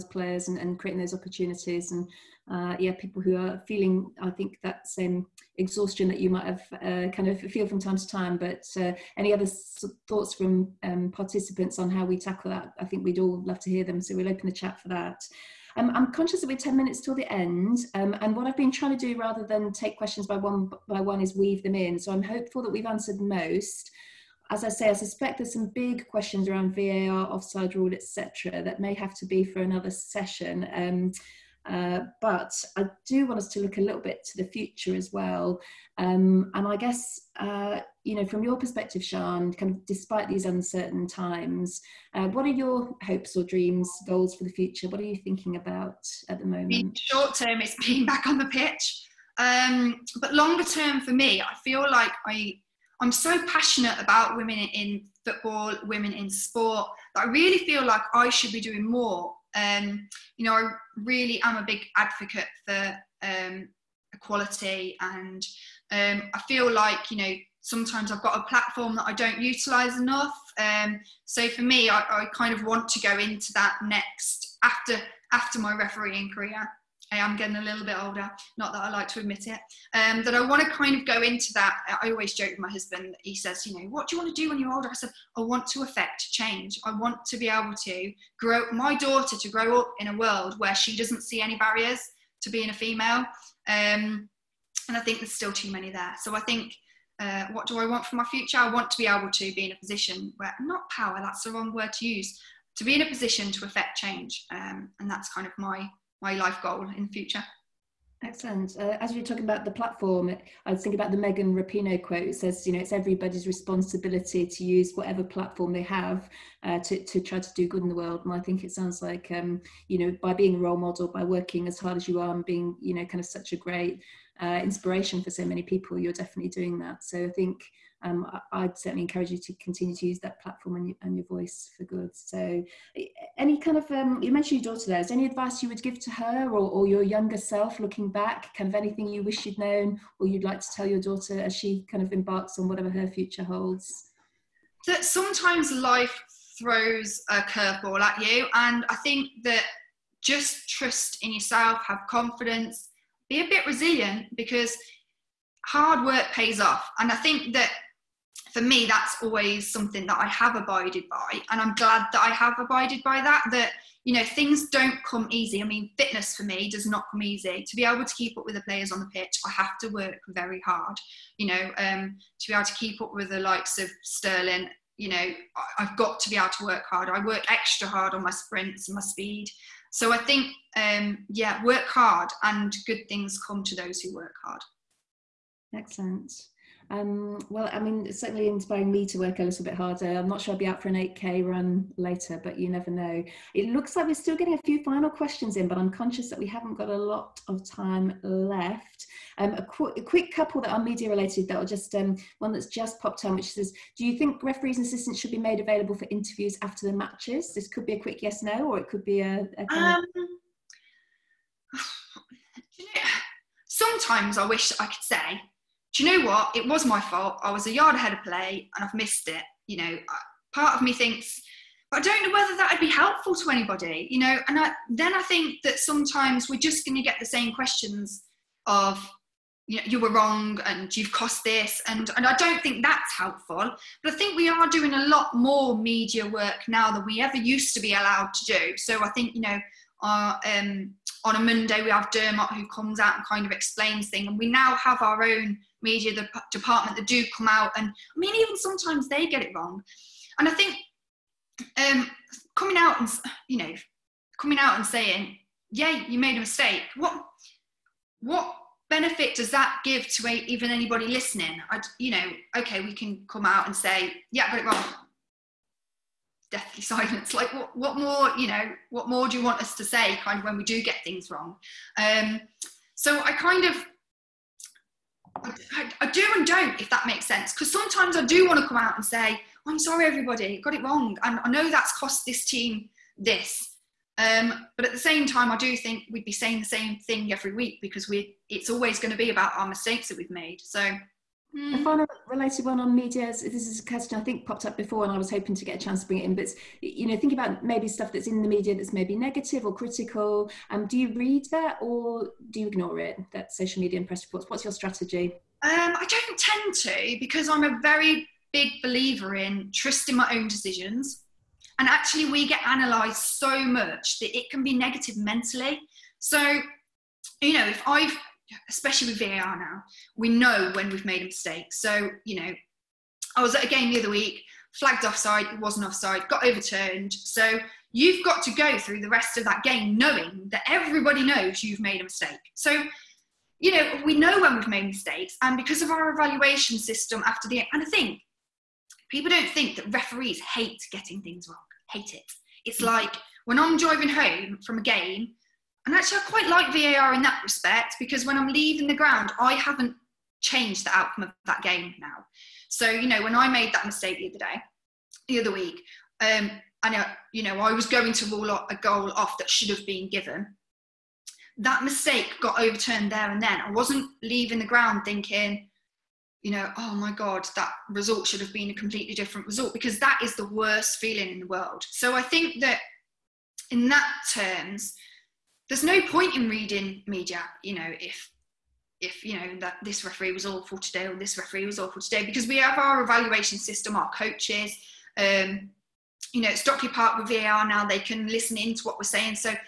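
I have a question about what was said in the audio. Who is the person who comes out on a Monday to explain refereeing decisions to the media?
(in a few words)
Dermot.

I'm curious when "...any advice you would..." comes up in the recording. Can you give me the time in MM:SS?
02:15.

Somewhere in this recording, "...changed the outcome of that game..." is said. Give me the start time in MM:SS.
05:50.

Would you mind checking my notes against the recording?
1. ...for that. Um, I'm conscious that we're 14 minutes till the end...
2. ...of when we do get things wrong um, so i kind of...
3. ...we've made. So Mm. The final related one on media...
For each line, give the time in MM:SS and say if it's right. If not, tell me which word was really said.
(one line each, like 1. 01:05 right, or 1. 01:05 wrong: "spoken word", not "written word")
1. 00:14 wrong: "10", not "14"
2. 04:30 right
3. 04:50 right.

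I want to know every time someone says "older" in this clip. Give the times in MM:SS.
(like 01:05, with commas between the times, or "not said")
01:18, 01:24.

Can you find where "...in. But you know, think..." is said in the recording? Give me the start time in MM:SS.
04:56.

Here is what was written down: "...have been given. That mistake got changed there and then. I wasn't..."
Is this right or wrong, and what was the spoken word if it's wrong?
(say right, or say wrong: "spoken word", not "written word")
wrong: "overturned", not "changed".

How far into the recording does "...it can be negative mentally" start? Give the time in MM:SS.
05:14.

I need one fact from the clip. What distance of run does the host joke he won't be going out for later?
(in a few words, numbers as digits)
8K.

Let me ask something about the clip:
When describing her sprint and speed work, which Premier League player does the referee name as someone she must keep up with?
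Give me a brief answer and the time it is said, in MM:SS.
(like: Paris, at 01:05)
Sterling, at 02:54.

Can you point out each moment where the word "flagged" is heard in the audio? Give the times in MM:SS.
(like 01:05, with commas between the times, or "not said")
05:24.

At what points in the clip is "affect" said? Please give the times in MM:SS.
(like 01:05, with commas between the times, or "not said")
01:25, 01:43.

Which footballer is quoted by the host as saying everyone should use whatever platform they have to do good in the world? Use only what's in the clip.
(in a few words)
Megan Rapinoe.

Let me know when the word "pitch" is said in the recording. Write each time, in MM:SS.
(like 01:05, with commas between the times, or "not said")
00:48, 02:49.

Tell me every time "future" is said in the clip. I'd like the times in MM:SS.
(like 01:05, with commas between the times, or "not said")
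00:34, 00:44, 01:38, 01:47, 02:23.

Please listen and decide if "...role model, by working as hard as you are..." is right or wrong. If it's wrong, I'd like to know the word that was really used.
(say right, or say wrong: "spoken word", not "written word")
right.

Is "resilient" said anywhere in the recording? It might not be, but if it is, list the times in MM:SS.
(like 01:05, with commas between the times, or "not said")
02:33.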